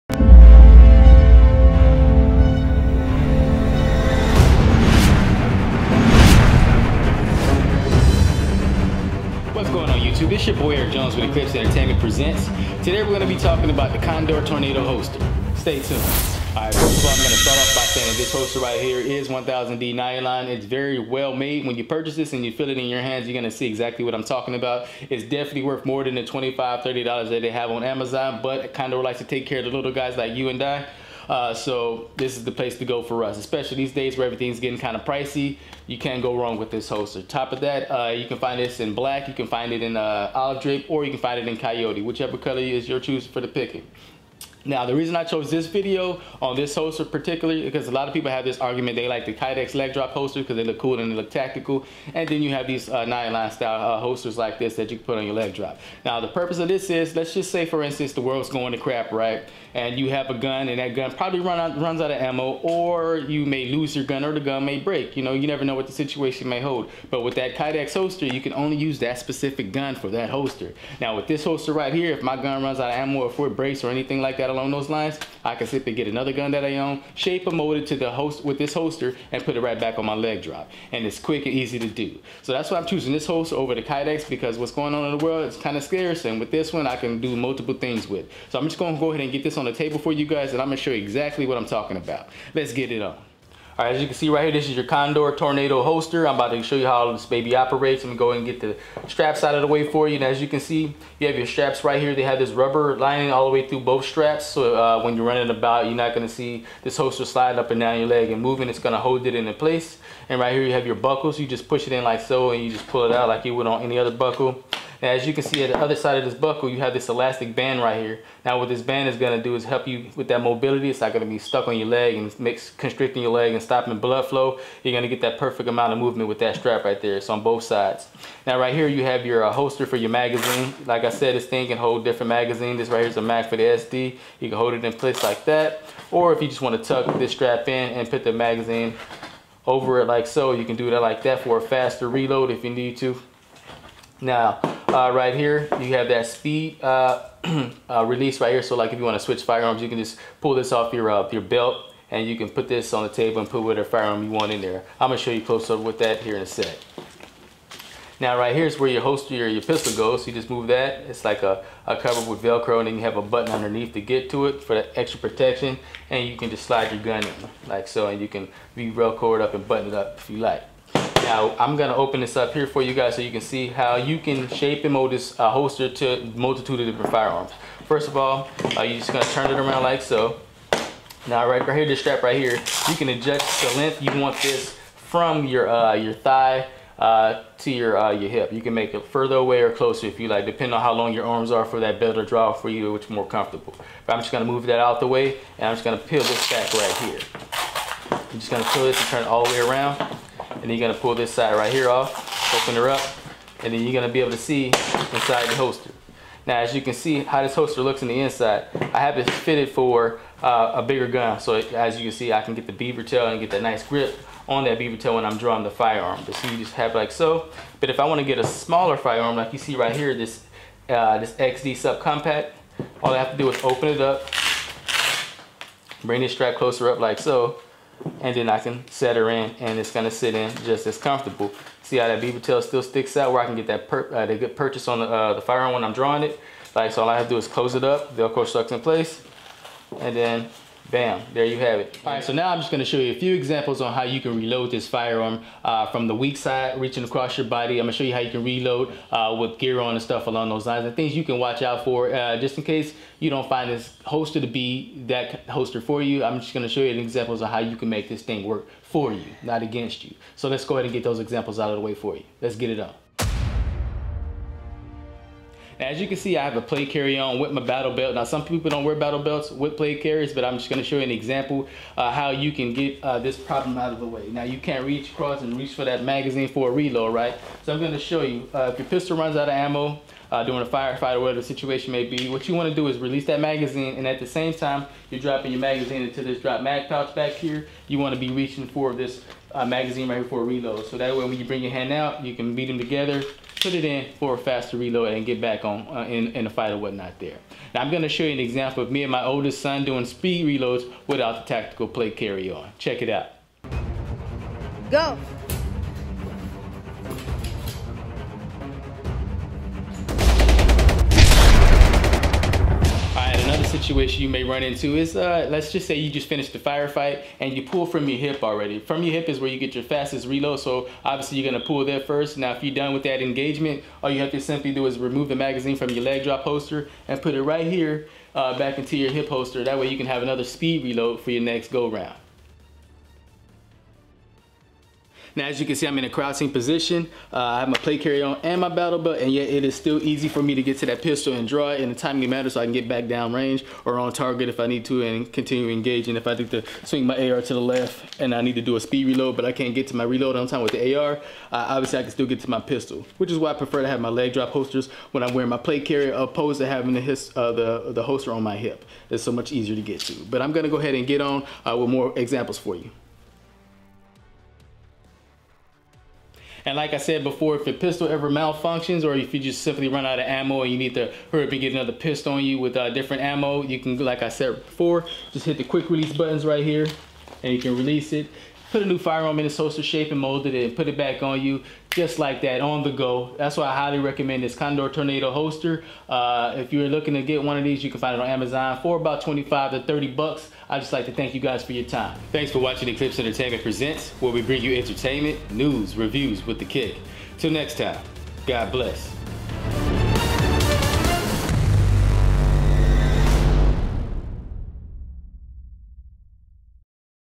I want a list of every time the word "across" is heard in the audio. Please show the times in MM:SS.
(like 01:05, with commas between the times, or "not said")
04:07, 04:35.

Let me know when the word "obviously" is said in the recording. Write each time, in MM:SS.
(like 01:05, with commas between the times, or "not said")
05:21, 05:51.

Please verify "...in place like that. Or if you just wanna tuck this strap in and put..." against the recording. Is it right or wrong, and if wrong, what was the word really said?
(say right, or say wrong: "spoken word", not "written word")
right.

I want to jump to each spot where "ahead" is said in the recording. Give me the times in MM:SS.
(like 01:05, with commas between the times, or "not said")
01:29, 04:20, 06:00.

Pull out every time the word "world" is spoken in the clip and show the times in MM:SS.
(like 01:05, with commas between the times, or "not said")
00:58, 01:25.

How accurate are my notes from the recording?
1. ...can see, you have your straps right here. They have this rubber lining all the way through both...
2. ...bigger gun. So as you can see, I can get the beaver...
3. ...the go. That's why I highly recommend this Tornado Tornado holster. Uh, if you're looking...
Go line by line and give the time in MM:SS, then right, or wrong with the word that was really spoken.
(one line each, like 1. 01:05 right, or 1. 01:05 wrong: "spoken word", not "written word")
1. 01:40 right
2. 03:30 right
3. 06:22 wrong: "Condor", not "Tornado".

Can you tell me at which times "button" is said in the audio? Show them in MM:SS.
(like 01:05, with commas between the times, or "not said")
02:43, 02:49, 06:16.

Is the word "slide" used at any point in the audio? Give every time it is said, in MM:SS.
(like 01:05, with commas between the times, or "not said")
01:47, 02:46.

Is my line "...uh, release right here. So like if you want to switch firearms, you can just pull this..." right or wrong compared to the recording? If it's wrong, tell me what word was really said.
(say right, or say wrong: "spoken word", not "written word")
right.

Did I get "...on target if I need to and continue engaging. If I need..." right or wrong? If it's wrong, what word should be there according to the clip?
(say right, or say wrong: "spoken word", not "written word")
right.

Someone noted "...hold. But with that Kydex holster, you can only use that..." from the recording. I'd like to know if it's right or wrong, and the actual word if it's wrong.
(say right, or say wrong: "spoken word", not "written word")
right.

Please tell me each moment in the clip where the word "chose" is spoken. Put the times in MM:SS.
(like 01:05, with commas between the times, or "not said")
00:45.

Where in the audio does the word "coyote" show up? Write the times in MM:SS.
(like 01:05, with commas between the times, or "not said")
00:41.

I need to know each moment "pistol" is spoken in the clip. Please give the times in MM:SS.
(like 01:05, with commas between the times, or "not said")
02:39, 04:38, 05:41, 05:52, 06:07, 06:11.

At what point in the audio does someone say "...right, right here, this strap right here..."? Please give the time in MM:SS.
03:01.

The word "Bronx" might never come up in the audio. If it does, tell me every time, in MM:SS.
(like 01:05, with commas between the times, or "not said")
not said.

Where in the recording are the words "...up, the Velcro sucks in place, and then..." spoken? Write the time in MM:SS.
03:57.